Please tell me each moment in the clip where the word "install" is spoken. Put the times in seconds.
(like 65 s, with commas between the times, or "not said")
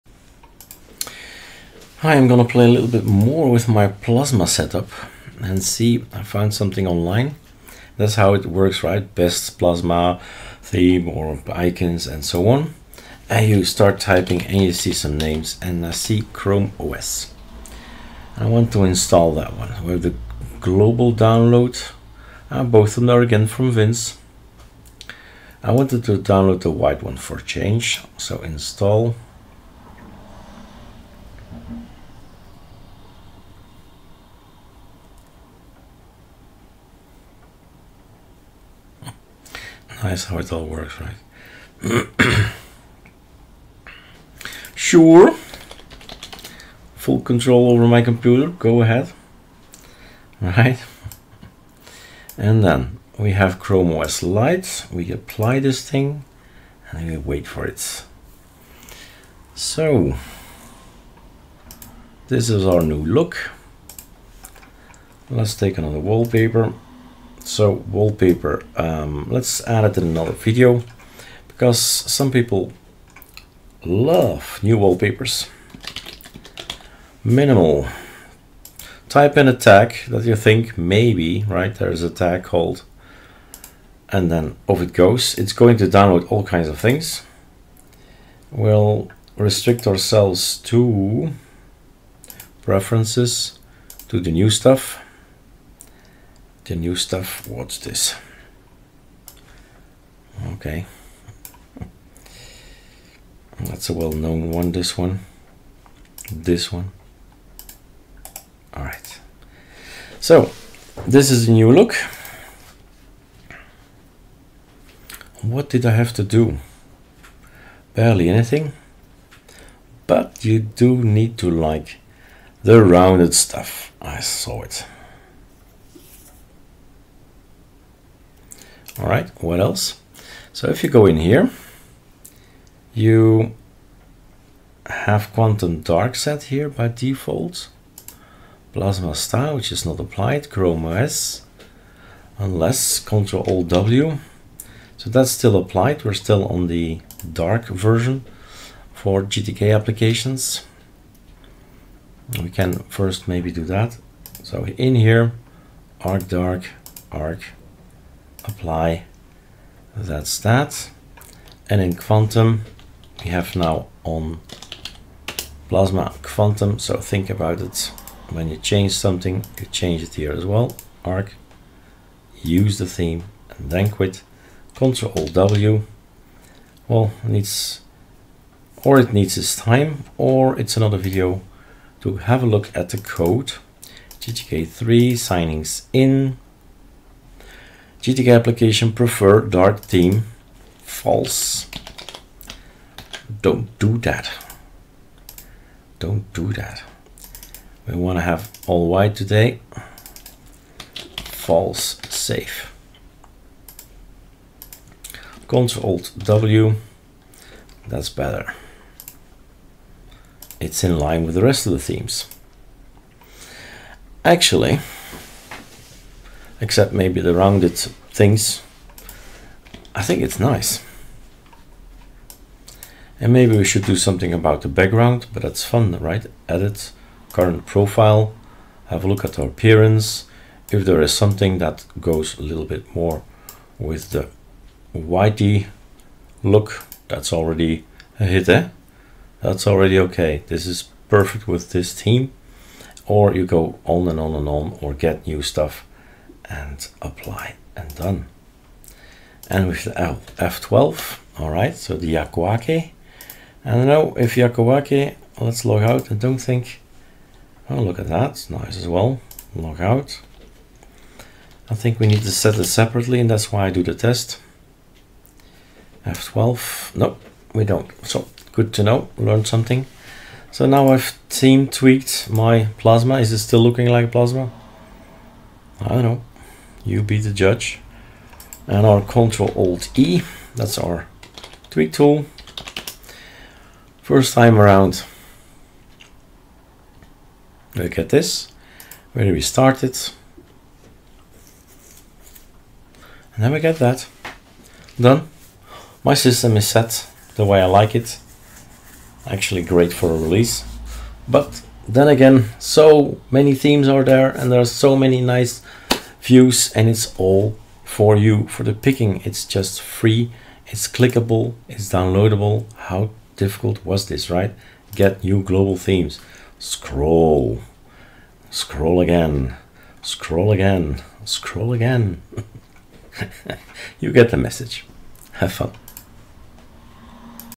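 18 s, 28 s.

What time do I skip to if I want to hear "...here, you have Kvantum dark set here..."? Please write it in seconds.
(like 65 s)
131 s.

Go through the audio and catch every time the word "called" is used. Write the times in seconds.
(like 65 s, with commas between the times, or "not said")
82 s.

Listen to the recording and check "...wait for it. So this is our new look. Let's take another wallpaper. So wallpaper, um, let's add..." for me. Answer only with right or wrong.
right.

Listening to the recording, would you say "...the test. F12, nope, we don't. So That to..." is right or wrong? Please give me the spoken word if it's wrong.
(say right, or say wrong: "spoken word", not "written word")
wrong: "Good", not "That".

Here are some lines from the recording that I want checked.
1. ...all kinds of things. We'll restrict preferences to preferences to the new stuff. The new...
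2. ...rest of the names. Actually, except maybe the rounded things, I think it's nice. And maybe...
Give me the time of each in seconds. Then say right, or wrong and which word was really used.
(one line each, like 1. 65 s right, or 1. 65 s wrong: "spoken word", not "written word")
1. 86 s wrong: "ourselves", not "preferences"
2. 211 s wrong: "themes", not "names".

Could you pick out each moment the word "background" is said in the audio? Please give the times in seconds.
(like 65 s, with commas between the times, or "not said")
224 s.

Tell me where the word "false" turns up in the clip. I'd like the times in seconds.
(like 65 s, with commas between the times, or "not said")
190 s, 201 s.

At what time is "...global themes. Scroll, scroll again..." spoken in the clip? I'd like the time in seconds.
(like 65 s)
315 s.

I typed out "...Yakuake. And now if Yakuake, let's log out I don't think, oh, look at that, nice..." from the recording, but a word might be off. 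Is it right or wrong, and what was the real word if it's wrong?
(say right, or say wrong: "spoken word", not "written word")
right.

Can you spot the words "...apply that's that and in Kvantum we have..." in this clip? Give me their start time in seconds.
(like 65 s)
158 s.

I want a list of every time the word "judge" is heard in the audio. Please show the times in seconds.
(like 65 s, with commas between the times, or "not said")
277 s.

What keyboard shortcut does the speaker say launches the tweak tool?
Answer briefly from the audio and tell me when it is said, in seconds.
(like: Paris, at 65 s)
Control Alt E, at 279 s.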